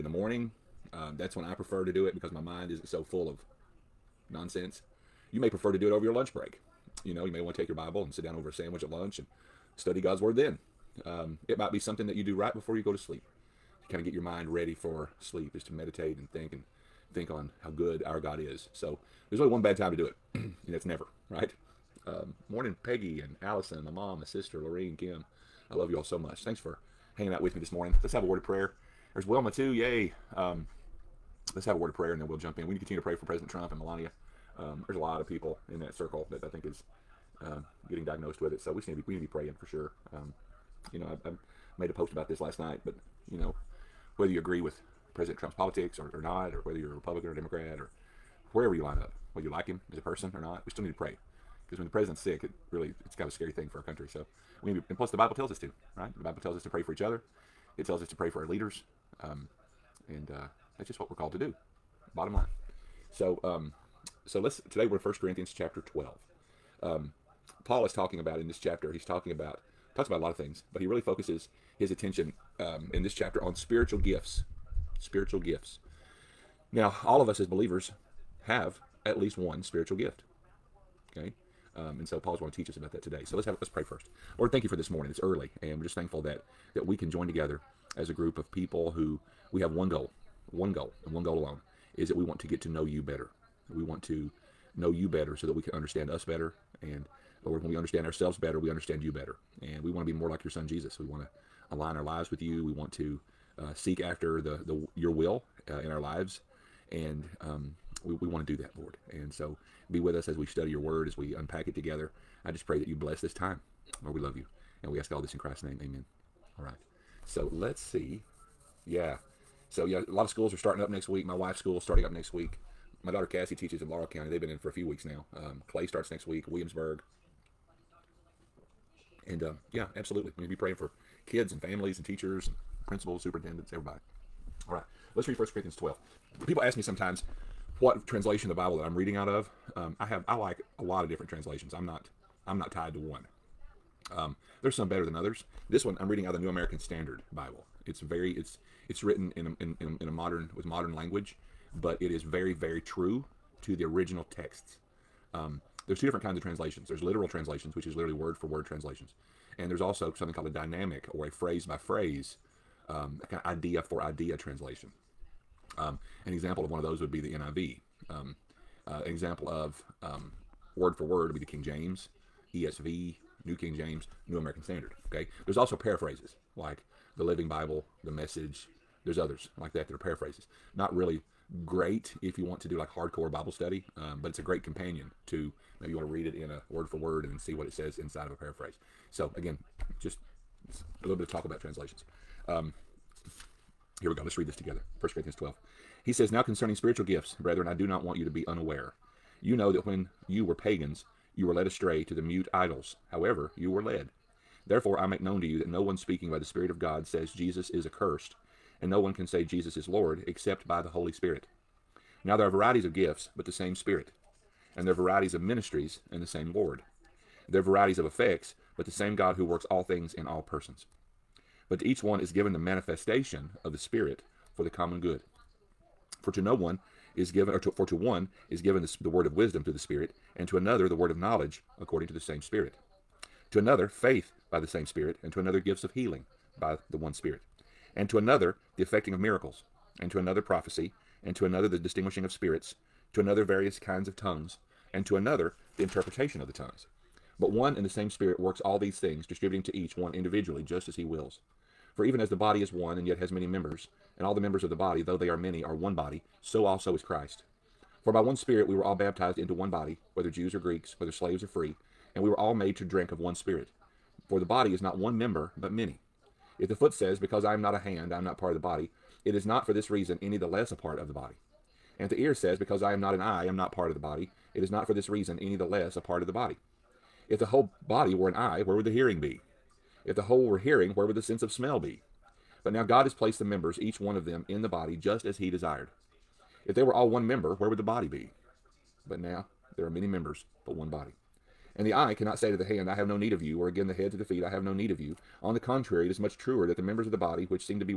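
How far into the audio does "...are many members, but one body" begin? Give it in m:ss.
4:49.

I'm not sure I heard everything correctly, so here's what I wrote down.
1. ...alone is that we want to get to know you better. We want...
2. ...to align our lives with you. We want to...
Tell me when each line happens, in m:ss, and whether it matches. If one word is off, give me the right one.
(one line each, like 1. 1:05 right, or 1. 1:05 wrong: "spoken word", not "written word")
1. 1:31 right
2. 1:41 right.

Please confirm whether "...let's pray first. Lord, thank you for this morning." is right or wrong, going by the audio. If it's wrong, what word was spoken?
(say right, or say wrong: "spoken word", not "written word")
right.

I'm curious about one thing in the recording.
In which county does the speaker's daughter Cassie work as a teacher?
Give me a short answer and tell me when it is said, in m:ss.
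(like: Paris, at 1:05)
Laurel County, at 2:03.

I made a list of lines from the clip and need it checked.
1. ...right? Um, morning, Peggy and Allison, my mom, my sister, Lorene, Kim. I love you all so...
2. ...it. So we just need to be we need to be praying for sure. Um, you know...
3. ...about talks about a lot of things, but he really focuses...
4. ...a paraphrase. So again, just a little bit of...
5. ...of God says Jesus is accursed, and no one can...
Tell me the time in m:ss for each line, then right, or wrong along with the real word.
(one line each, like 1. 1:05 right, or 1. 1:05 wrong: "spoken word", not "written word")
1. 0:21 right
2. 0:38 right
3. 1:09 right
4. 3:08 right
5. 3:26 right.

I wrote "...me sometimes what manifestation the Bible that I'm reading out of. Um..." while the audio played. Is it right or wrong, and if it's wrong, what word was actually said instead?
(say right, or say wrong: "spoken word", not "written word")
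wrong: "translation", not "manifestation".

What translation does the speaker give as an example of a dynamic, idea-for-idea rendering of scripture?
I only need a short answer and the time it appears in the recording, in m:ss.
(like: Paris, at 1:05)
NIV, at 2:47.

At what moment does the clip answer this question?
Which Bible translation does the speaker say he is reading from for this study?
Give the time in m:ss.
2:26.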